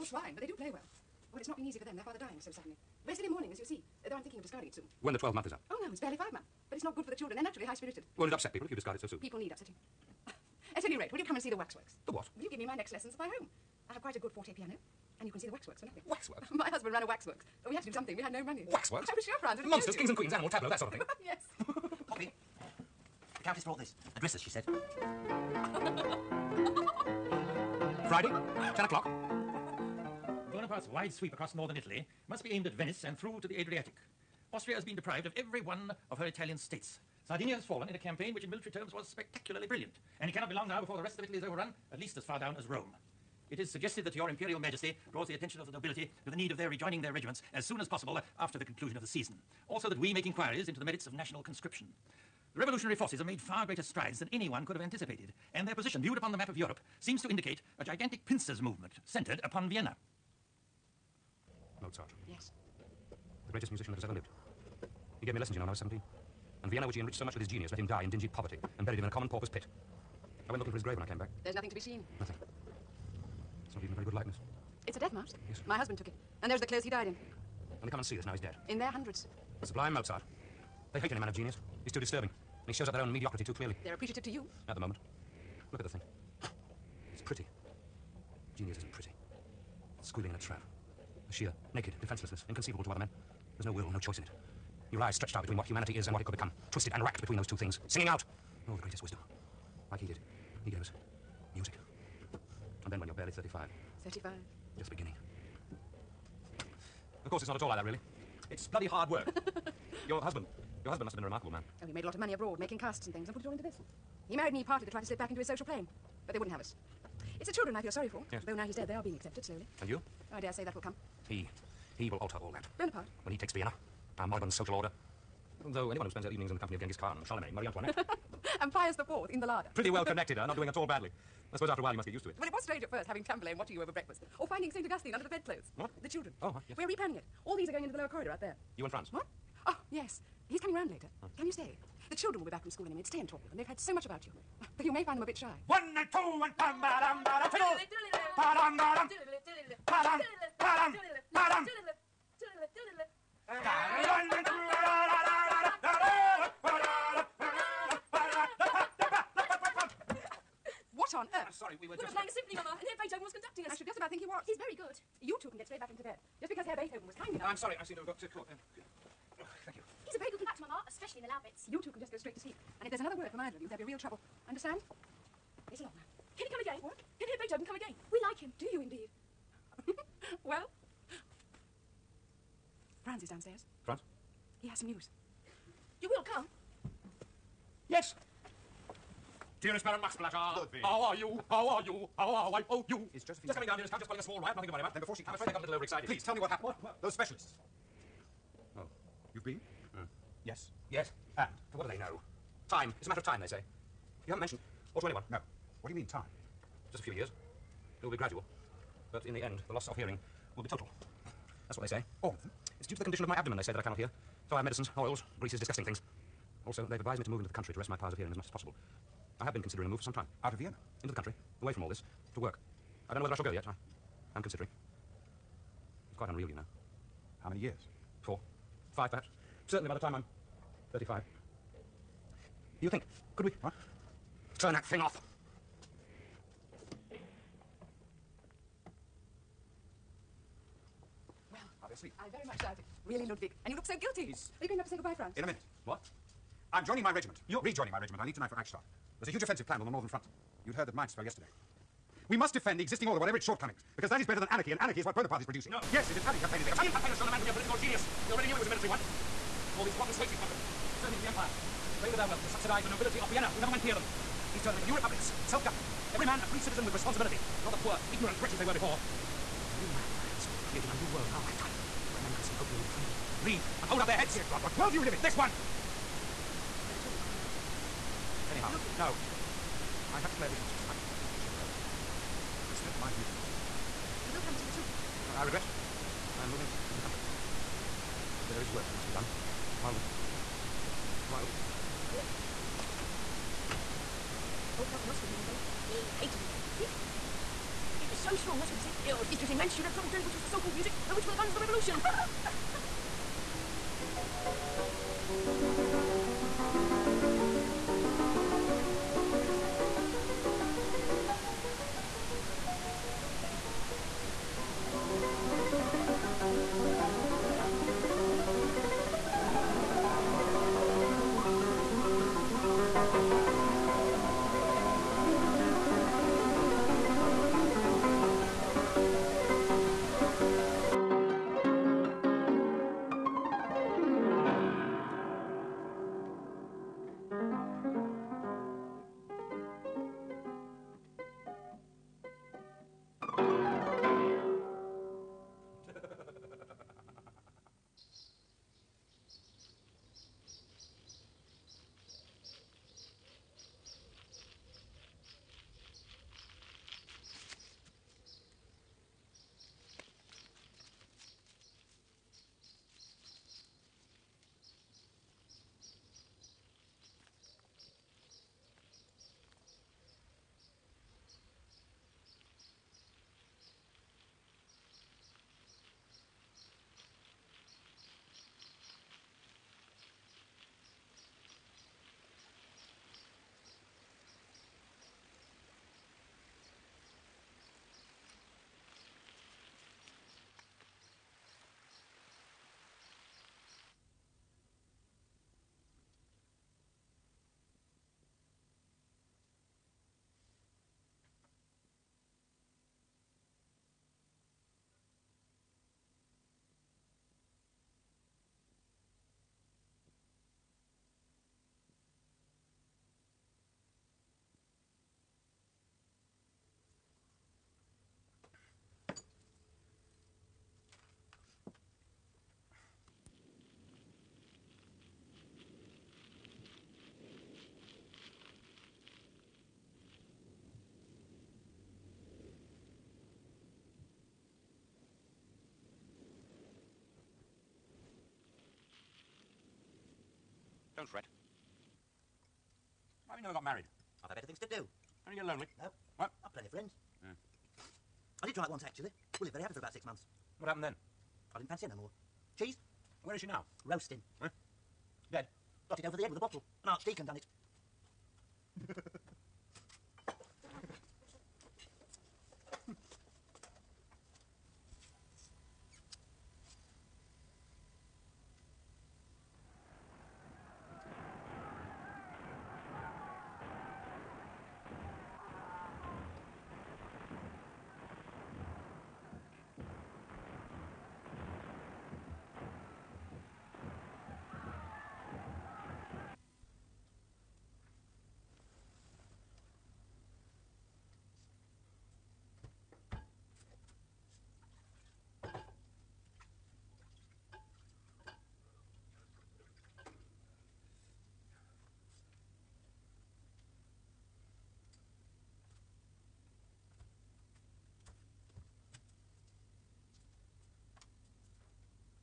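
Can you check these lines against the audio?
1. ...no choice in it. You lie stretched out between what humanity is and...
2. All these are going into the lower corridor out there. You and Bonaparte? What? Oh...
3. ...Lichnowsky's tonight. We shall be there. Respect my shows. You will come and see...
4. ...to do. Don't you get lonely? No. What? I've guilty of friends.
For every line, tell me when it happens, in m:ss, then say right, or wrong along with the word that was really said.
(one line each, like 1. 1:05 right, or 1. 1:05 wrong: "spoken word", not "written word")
1. 1:33 right
2. 2:17 wrong: "Franz", not "Bonaparte"
3. 4:40 wrong: "views", not "shows"
4. 7:24 wrong: "plenty", not "guilty".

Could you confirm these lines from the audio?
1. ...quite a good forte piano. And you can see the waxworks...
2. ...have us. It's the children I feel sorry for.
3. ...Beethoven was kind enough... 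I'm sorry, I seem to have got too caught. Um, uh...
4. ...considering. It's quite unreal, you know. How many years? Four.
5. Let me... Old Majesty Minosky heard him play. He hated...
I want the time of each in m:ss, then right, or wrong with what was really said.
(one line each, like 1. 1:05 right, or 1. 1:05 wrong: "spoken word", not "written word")
1. 0:14 right
2. 1:56 right
3. 2:46 right
4. 3:44 right
5. 4:52 wrong: "Count", not "Majesty".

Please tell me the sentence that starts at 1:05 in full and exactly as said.
He gave me lessons, you know, when I was 17.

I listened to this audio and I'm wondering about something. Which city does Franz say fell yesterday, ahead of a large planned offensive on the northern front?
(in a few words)
Mainz.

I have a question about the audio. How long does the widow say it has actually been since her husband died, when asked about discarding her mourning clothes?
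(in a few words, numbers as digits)
5 months.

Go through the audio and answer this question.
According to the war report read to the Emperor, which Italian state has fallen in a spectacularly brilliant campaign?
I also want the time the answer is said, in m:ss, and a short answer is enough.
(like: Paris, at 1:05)
Sardinia, at 0:37.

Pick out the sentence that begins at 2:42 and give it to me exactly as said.
We were playing a symphony, Mama, and here Beethoven was conducting us.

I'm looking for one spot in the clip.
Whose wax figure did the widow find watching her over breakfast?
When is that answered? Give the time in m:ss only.
2:13.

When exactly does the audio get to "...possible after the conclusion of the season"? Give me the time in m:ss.
0:47.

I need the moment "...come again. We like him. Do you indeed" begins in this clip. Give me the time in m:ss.
2:57.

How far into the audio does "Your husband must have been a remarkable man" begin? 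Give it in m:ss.
1:50.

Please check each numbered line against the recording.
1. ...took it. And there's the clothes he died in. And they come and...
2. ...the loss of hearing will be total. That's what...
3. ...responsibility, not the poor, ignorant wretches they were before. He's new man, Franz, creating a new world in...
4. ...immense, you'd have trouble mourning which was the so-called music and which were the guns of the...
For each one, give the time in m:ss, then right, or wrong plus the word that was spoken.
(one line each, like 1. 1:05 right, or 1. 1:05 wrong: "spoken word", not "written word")
1. 1:15 right
2. 3:29 right
3. 4:26 right
4. 4:59 wrong: "telling", not "mourning".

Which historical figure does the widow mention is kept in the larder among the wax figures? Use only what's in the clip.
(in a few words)
Pius Fourth.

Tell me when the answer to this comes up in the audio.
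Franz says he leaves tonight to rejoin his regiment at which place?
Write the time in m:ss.
4:08.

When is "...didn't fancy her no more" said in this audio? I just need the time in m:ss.
7:31.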